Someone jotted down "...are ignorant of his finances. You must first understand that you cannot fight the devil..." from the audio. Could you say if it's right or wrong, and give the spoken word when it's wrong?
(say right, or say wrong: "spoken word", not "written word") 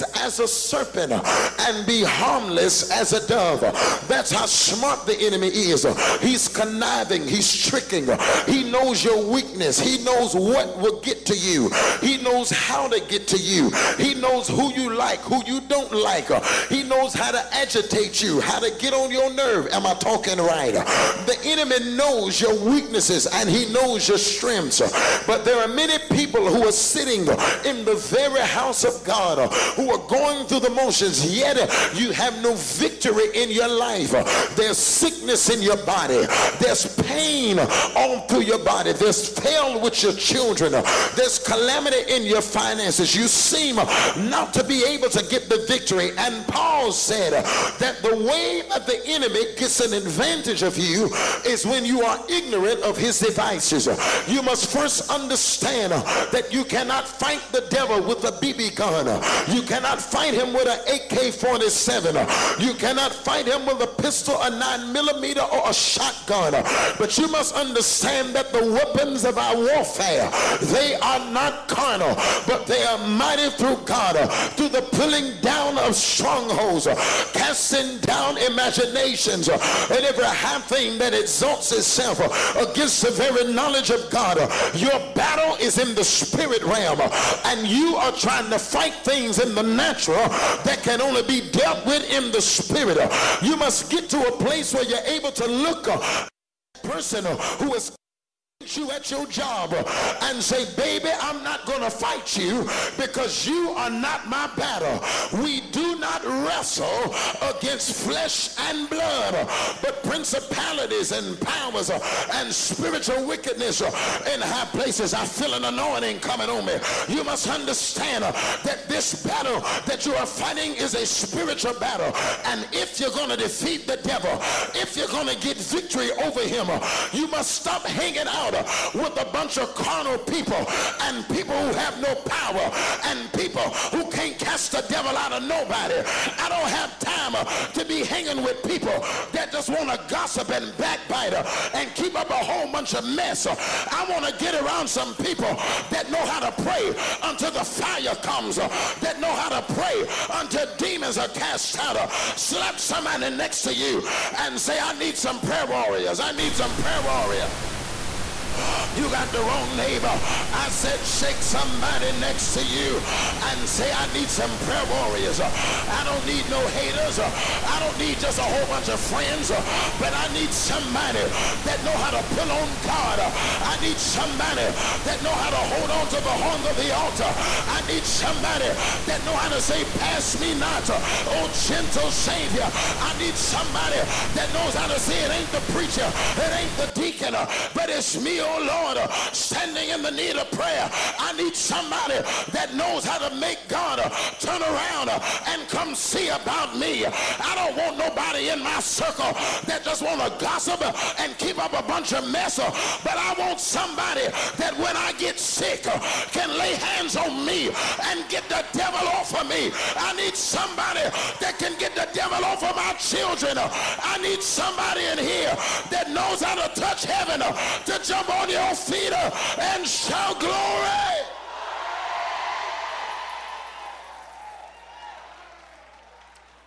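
wrong: "devices", not "finances".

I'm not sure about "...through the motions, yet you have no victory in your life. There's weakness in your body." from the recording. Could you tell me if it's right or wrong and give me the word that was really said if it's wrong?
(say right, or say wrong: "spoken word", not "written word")
wrong: "sickness", not "weakness".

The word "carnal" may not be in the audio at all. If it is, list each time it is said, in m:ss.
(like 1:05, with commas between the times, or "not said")
1:11, 2:09.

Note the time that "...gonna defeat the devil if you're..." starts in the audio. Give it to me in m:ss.
2:03.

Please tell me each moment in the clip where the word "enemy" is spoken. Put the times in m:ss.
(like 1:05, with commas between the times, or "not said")
0:05, 0:21, 0:49.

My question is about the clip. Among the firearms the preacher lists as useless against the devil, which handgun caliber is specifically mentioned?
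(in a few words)
9 millimeter.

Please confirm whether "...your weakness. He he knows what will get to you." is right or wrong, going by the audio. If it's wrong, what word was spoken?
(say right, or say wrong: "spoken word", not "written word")
right.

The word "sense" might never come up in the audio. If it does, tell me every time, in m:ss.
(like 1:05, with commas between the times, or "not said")
not said.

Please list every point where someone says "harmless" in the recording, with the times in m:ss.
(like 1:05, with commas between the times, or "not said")
0:02.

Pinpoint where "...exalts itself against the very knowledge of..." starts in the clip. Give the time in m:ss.
1:21.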